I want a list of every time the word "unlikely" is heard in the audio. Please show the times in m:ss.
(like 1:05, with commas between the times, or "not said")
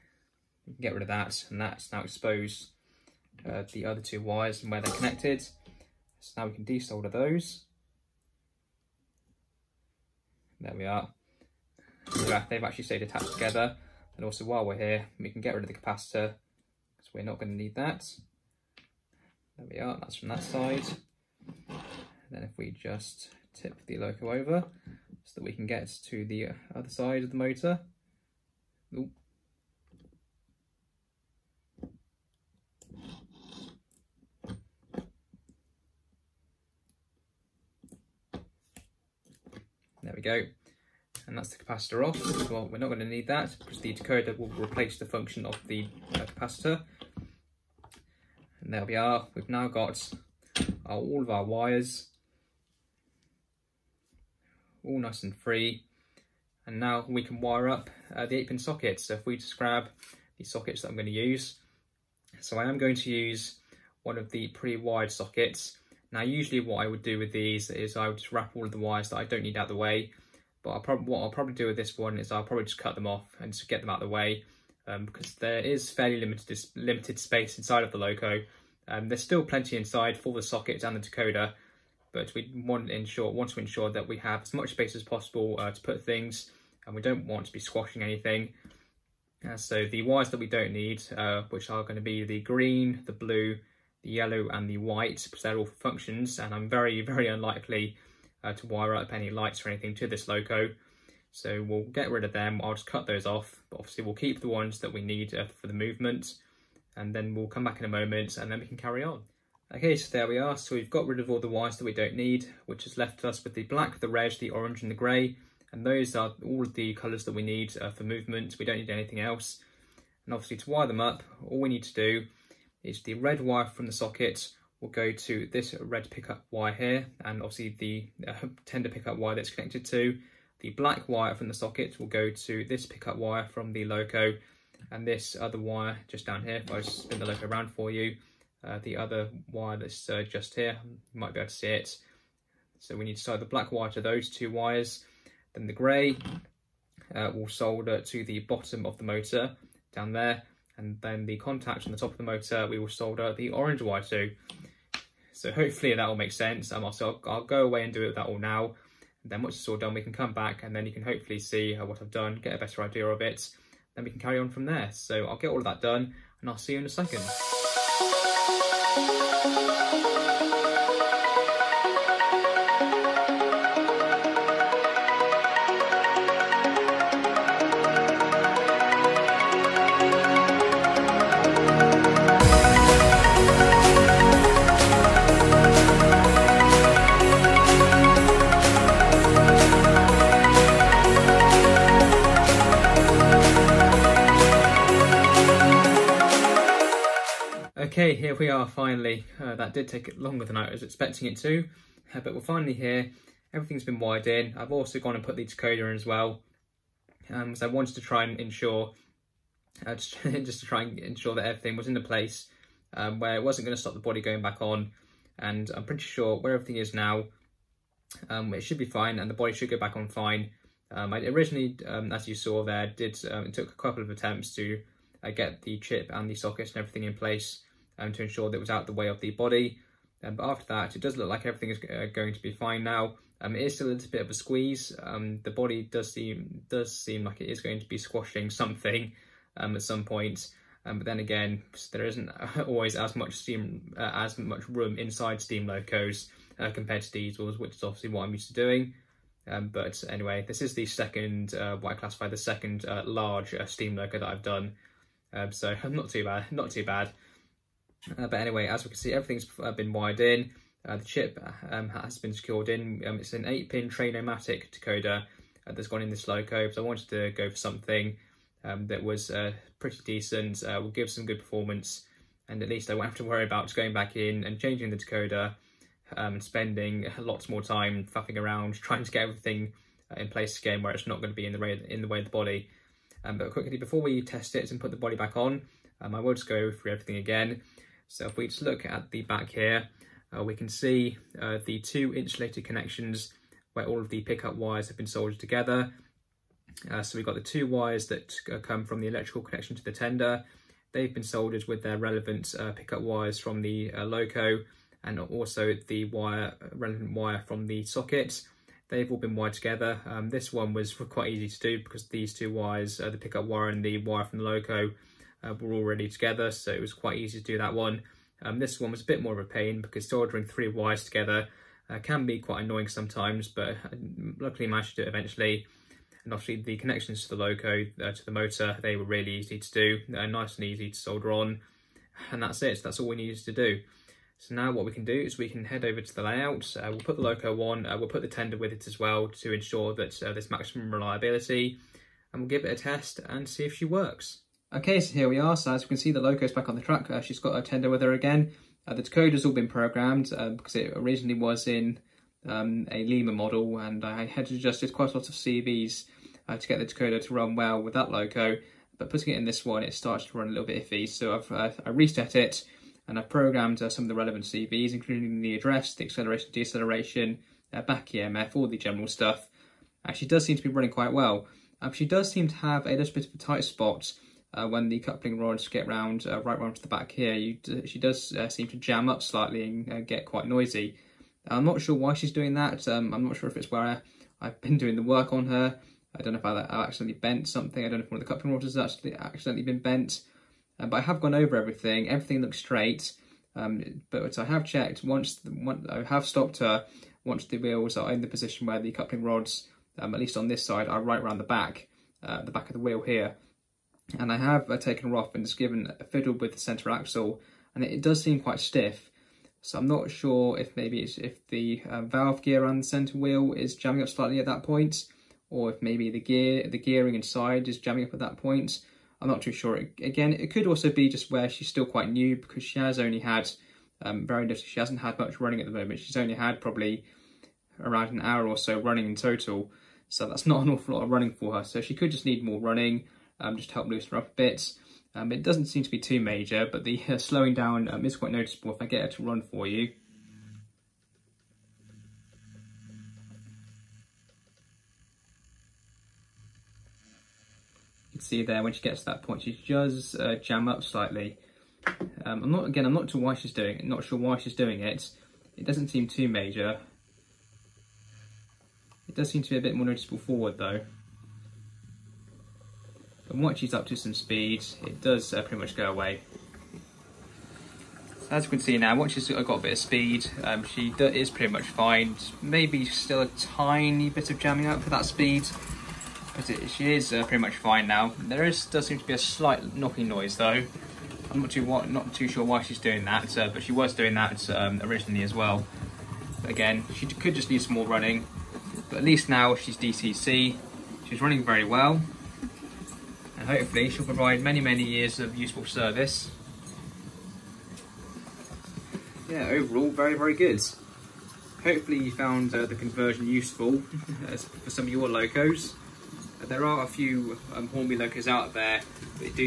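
1:37.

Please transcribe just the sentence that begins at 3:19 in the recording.
Uh, that did take longer than I was expecting it to, uh, but we're finally here.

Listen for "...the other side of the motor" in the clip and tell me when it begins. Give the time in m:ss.
0:26.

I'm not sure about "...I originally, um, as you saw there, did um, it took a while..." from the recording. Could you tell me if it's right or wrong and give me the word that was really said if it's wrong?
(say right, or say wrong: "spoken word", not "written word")
wrong: "couple", not "while".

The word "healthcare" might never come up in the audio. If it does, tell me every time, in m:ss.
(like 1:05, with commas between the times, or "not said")
not said.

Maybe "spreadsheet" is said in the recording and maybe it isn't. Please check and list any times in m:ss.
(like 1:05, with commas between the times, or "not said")
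not said.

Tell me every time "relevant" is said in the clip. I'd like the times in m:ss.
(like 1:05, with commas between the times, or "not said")
5:01, 5:06, 6:04.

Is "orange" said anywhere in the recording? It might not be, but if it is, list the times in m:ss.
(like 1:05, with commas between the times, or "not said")
1:54, 2:33.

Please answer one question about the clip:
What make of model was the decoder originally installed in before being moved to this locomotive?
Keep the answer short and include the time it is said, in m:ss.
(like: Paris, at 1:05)
Lima, at 5:53.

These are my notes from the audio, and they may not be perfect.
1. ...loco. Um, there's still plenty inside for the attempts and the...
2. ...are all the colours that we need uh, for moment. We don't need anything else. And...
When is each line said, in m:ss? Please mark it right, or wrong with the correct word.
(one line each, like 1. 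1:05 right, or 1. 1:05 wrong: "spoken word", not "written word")
1. 1:17 wrong: "sockets", not "attempts"
2. 1:56 wrong: "movement", not "moment".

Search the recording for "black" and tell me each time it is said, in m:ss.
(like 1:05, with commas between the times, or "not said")
1:53, 2:10, 2:23.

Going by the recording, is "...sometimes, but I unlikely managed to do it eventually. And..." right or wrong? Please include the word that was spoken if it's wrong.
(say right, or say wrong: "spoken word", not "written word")
wrong: "luckily", not "unlikely".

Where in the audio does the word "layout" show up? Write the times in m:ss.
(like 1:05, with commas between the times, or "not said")
5:36.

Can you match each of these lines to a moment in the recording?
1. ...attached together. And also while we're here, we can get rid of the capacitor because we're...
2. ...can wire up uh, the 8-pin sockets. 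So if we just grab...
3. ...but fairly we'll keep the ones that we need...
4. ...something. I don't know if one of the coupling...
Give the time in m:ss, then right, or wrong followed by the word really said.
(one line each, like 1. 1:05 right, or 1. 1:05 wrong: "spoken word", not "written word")
1. 0:13 right
2. 0:57 right
3. 1:43 wrong: "obviously", not "fairly"
4. 6:27 right.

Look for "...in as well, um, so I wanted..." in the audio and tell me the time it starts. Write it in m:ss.
3:25.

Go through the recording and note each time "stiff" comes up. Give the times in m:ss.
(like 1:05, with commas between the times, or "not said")
6:48.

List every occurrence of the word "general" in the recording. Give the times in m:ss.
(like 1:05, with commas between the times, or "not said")
6:08.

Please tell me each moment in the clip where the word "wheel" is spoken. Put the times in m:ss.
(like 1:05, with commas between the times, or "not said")
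6:37, 6:42, 6:53.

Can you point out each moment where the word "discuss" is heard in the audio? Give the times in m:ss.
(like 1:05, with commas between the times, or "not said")
not said.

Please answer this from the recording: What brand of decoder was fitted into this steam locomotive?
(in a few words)
Train-O-Matic.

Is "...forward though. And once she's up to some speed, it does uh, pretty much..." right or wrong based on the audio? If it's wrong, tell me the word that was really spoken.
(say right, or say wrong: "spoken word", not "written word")
right.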